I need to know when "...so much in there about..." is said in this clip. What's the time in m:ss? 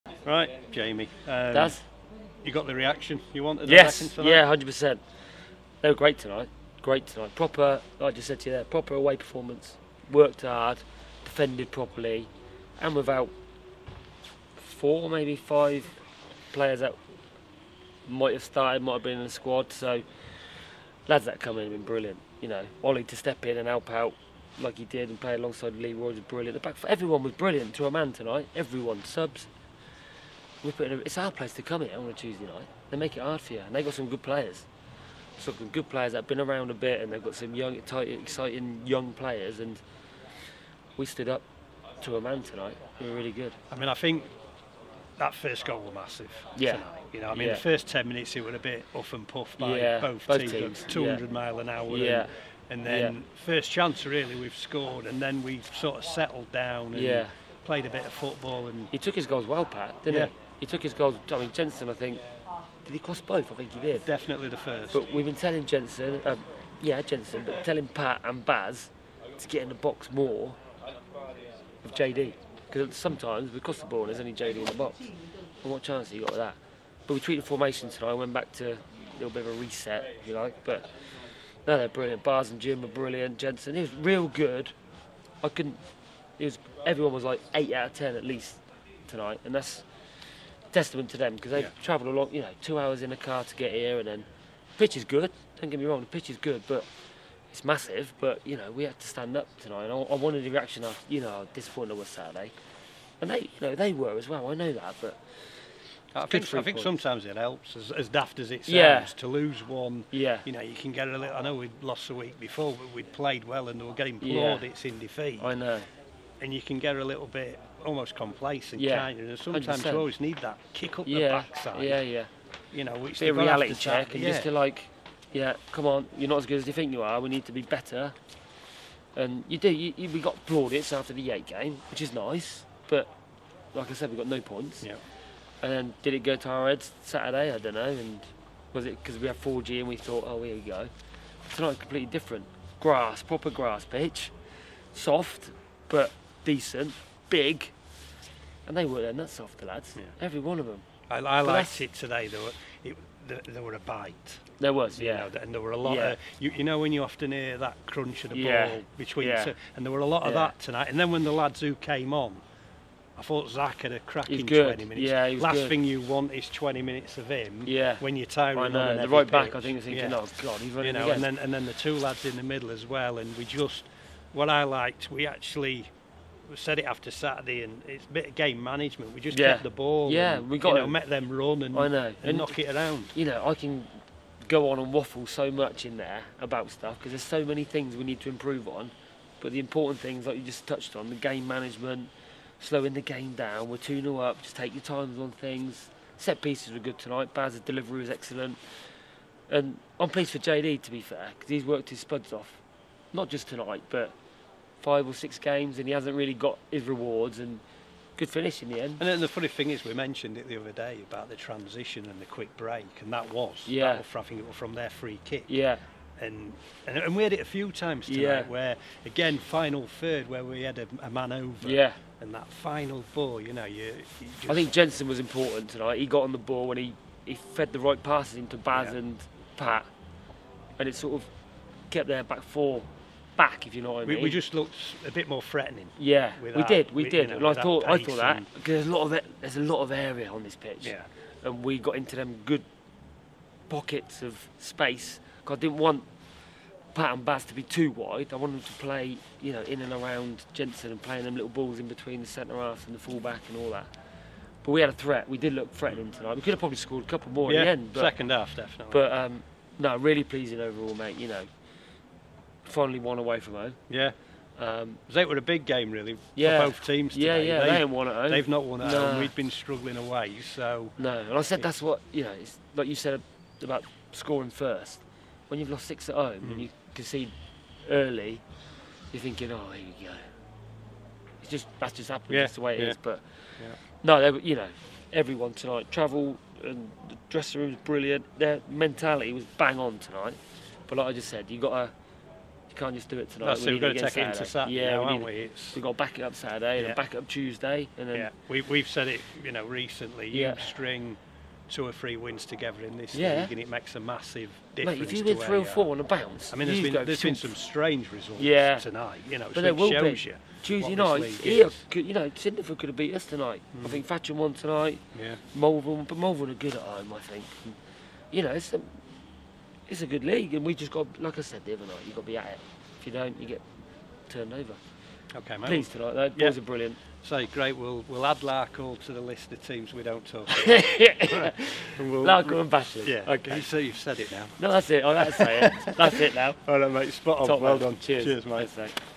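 3:05.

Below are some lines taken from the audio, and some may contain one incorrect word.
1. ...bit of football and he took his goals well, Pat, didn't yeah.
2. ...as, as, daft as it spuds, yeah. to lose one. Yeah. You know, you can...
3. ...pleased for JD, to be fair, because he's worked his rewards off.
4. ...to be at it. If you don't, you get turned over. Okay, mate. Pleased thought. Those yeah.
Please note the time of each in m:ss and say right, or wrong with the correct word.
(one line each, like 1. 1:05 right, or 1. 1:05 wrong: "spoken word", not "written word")
1. 0:57 right
2. 1:47 wrong: "sounds", not "spuds"
3. 3:20 wrong: "spuds", not "rewards"
4. 5:22 wrong: "tonight", not "thought".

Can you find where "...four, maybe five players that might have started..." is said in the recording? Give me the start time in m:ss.
0:14.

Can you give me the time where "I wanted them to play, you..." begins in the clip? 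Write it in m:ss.
4:08.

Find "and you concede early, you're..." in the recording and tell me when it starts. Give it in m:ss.
4:36.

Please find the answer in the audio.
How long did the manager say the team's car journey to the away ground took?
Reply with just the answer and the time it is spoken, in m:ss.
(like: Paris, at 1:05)
2 hours, at 1:32.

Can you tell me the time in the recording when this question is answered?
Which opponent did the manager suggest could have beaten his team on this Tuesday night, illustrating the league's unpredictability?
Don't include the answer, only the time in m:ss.
5:12.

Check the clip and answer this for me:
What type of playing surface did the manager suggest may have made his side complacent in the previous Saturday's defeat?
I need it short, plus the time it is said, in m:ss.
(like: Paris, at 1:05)
4G, at 2:19.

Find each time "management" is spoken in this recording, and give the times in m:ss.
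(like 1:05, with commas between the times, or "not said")
2:58, 3:11.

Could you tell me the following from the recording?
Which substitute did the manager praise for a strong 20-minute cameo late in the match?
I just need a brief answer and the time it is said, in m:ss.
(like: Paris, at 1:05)
Zach, at 2:43.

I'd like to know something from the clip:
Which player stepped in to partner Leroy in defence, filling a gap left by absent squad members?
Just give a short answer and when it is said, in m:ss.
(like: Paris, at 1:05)
Ollie, at 0:22.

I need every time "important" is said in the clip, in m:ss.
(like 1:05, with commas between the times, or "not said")
3:09, 3:45.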